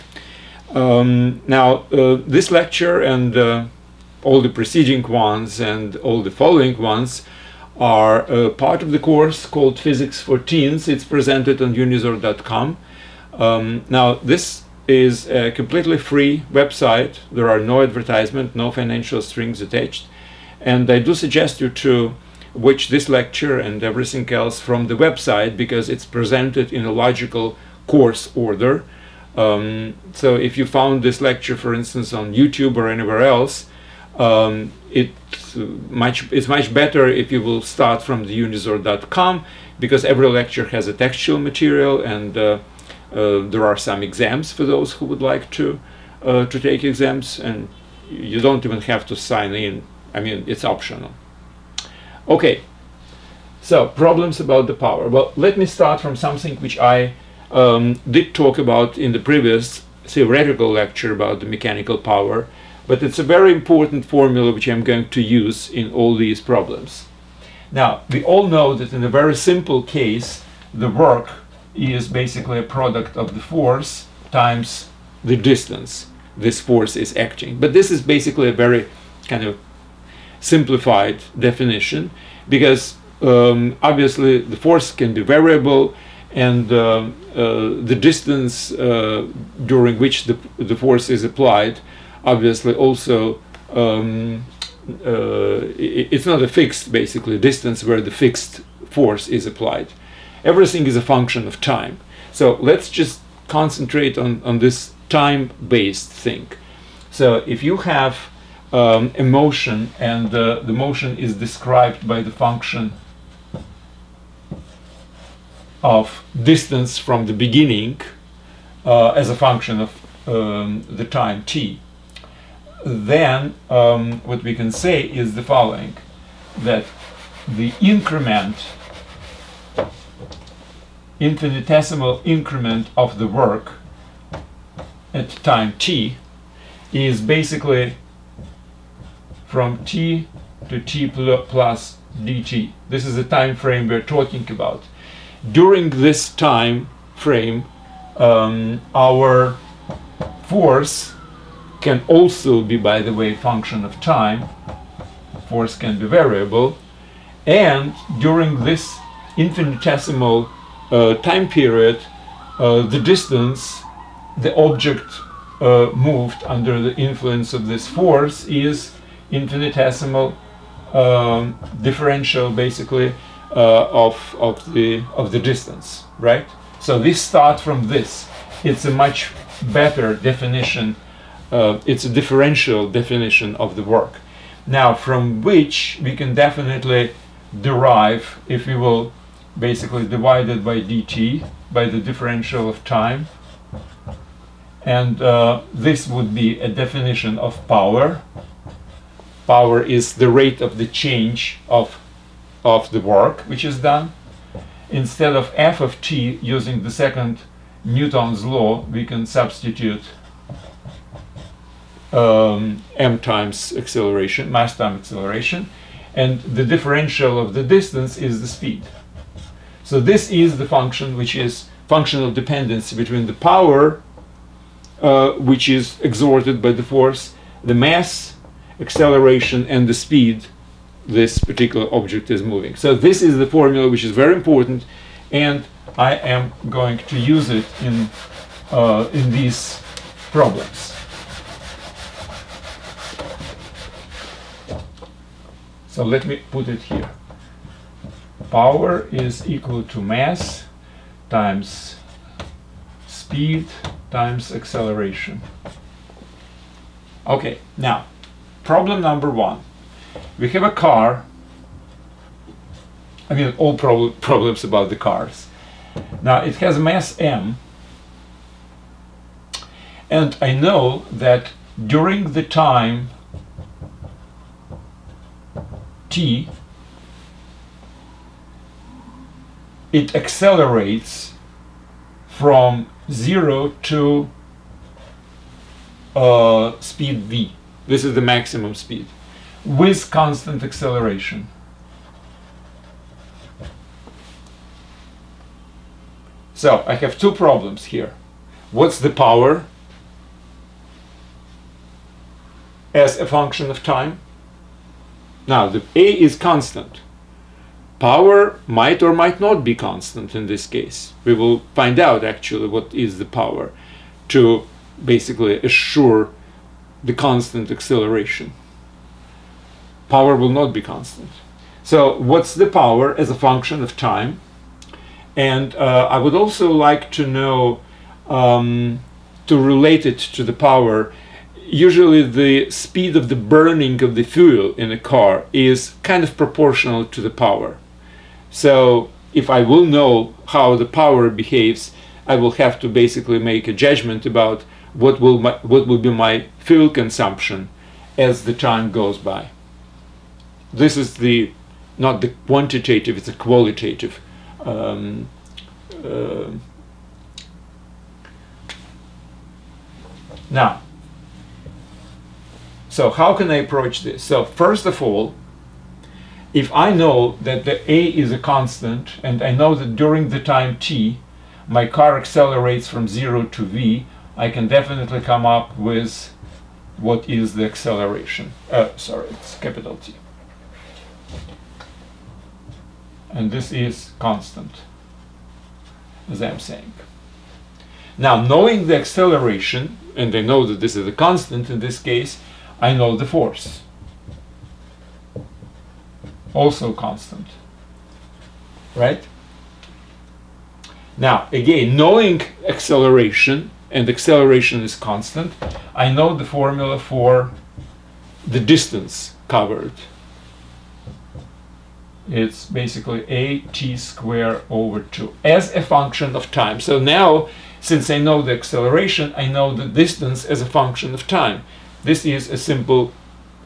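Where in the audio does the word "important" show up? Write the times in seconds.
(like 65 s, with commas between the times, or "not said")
63 s, 234 s.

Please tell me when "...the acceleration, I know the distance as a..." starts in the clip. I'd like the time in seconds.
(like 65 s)
418 s.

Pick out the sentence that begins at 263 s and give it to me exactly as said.
I mean, all prob problems about the cars.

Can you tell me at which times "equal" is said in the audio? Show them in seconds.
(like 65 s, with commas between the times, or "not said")
249 s.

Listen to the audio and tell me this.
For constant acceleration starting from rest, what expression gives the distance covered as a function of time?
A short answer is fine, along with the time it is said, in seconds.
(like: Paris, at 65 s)
a t squared over 2, at 413 s.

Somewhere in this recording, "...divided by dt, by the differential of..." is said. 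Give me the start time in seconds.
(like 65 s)
190 s.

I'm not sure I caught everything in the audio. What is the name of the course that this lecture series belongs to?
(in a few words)
Physics for Teens.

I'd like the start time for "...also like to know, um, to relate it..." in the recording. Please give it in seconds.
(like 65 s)
326 s.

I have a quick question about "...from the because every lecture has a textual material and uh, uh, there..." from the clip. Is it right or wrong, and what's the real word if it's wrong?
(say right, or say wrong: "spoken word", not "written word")
right.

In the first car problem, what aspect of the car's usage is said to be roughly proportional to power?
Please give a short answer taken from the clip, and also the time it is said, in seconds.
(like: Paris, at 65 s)
burning of the fuel, at 333 s.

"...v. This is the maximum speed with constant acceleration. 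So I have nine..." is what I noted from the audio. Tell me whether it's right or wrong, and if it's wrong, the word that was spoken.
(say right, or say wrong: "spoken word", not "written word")
wrong: "two", not "nine".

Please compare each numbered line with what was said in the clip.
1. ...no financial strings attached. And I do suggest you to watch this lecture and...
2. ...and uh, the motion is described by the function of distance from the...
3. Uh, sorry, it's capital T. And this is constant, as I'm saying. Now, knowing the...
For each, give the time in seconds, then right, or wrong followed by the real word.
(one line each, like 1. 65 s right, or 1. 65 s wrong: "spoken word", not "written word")
1. 18 s right
2. 109 s right
3. 378 s right.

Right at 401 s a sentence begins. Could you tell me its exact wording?
Now, again, knowing acceleration, and acceleration is constant, I know the formula for the distance covered.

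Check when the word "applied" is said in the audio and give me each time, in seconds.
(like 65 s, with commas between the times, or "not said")
91 s, 99 s.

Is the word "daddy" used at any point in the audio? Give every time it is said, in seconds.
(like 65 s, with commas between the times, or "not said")
not said.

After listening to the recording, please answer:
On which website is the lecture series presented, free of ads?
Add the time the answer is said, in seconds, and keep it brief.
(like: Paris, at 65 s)
unizor.com, at 11 s.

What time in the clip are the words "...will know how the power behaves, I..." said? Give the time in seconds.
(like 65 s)
339 s.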